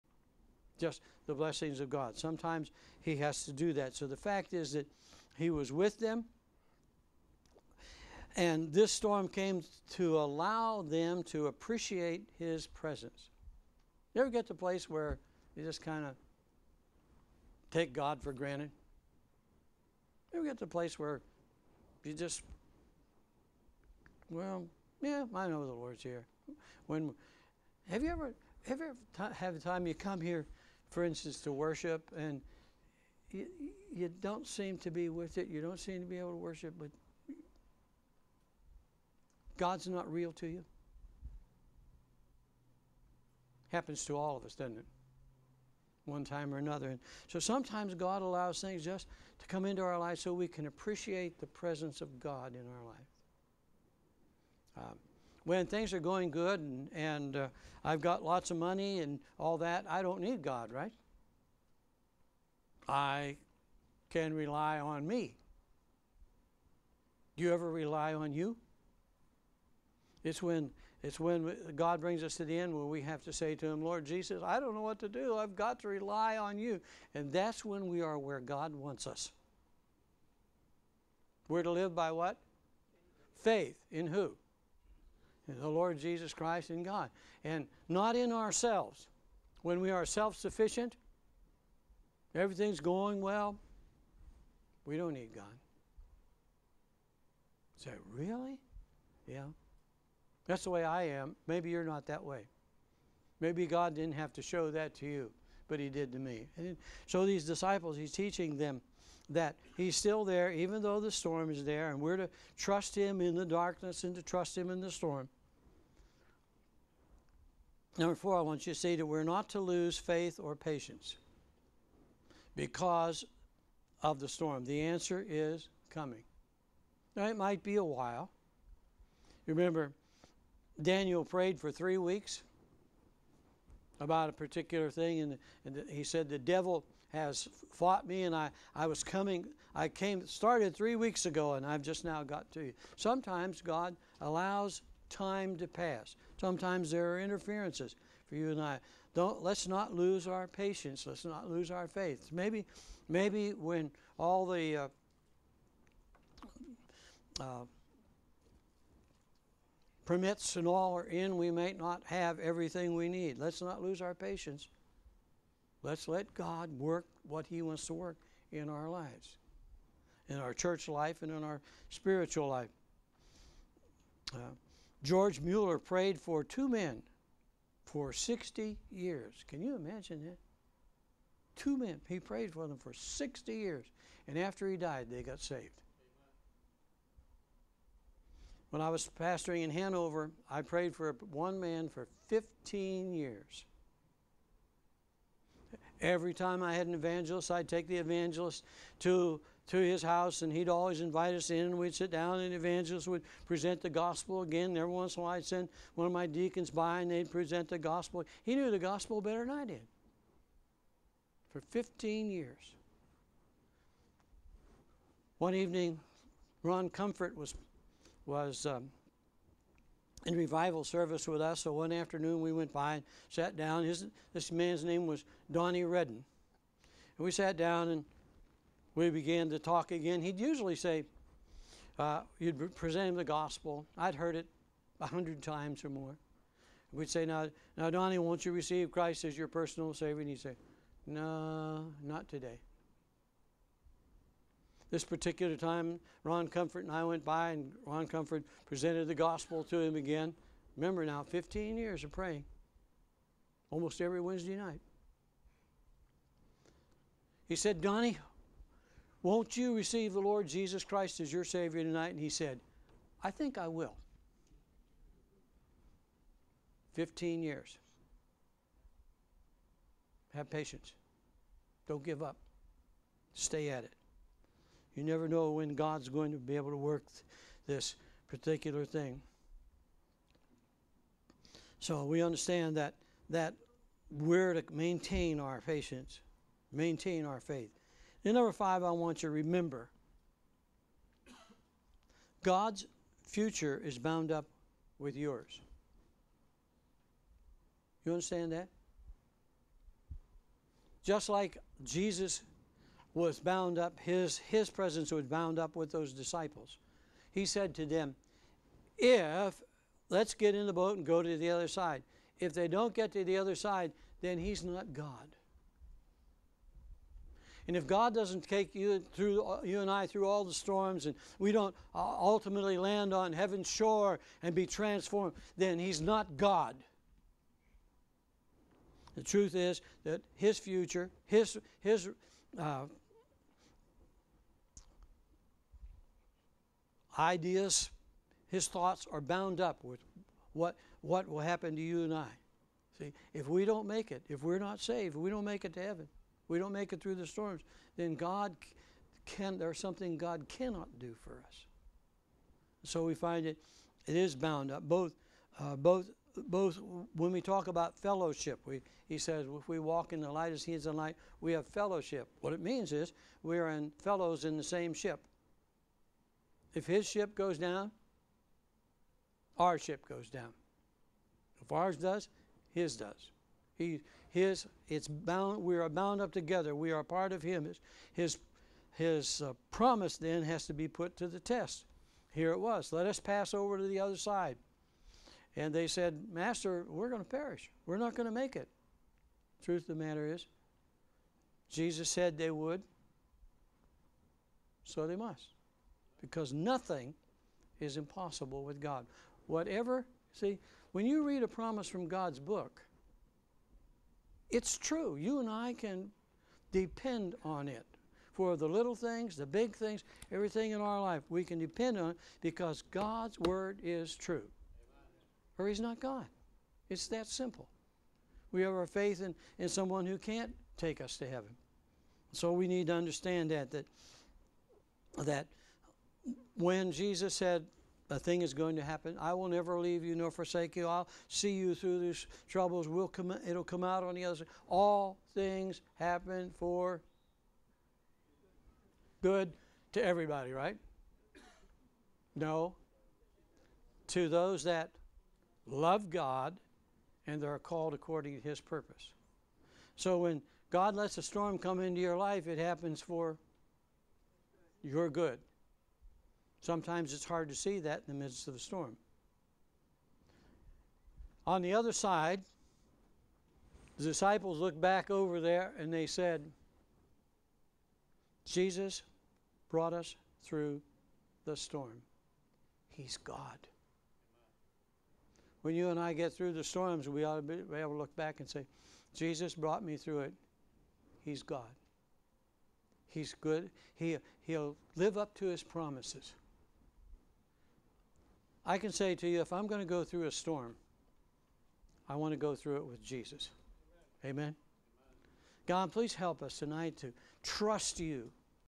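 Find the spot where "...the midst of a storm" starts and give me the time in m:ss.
7:38.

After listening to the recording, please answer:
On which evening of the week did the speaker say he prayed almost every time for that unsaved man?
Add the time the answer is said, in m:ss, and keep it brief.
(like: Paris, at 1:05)
Wednesday, at 4:14.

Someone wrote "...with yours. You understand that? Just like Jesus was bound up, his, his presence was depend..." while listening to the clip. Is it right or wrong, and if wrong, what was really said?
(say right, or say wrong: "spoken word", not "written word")
wrong: "bound", not "depend".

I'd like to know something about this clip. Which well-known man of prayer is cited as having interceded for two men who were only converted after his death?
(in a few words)
George Mueller.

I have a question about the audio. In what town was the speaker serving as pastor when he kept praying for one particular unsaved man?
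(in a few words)
Hanover.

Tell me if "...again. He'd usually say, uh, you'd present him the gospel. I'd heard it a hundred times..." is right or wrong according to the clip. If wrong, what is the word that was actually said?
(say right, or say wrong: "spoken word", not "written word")
right.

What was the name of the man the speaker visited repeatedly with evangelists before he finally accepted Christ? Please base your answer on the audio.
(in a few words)
Donnie Redden.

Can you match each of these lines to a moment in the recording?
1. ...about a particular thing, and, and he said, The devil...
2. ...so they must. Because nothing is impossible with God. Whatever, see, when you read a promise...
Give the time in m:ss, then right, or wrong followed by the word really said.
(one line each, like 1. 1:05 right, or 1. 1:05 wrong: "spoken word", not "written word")
1. 2:13 right
2. 6:34 right.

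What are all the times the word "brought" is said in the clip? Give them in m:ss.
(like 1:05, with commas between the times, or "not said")
7:49, 7:59.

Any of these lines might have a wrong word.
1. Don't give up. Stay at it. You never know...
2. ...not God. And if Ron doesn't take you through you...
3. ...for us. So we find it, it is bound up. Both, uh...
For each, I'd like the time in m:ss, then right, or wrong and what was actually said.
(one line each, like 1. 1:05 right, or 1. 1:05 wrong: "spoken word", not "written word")
1. 4:31 right
2. 5:14 wrong: "God", not "Ron"
3. 5:51 right.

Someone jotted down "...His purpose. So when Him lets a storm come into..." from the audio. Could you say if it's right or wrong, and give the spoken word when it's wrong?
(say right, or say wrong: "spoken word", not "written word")
wrong: "God", not "Him".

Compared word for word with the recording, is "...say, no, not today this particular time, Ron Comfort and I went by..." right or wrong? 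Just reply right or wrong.
right.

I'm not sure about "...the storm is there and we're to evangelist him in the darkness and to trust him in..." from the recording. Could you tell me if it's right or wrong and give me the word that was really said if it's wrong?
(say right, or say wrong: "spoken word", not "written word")
wrong: "trust", not "evangelist".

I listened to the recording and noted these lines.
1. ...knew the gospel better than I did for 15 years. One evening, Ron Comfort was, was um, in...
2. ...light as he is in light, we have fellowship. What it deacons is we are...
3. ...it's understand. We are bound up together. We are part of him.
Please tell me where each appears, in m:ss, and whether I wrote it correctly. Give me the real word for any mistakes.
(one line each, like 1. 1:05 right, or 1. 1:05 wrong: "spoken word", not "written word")
1. 3:28 right
2. 6:00 wrong: "means", not "deacons"
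3. 6:14 wrong: "bound", not "understand".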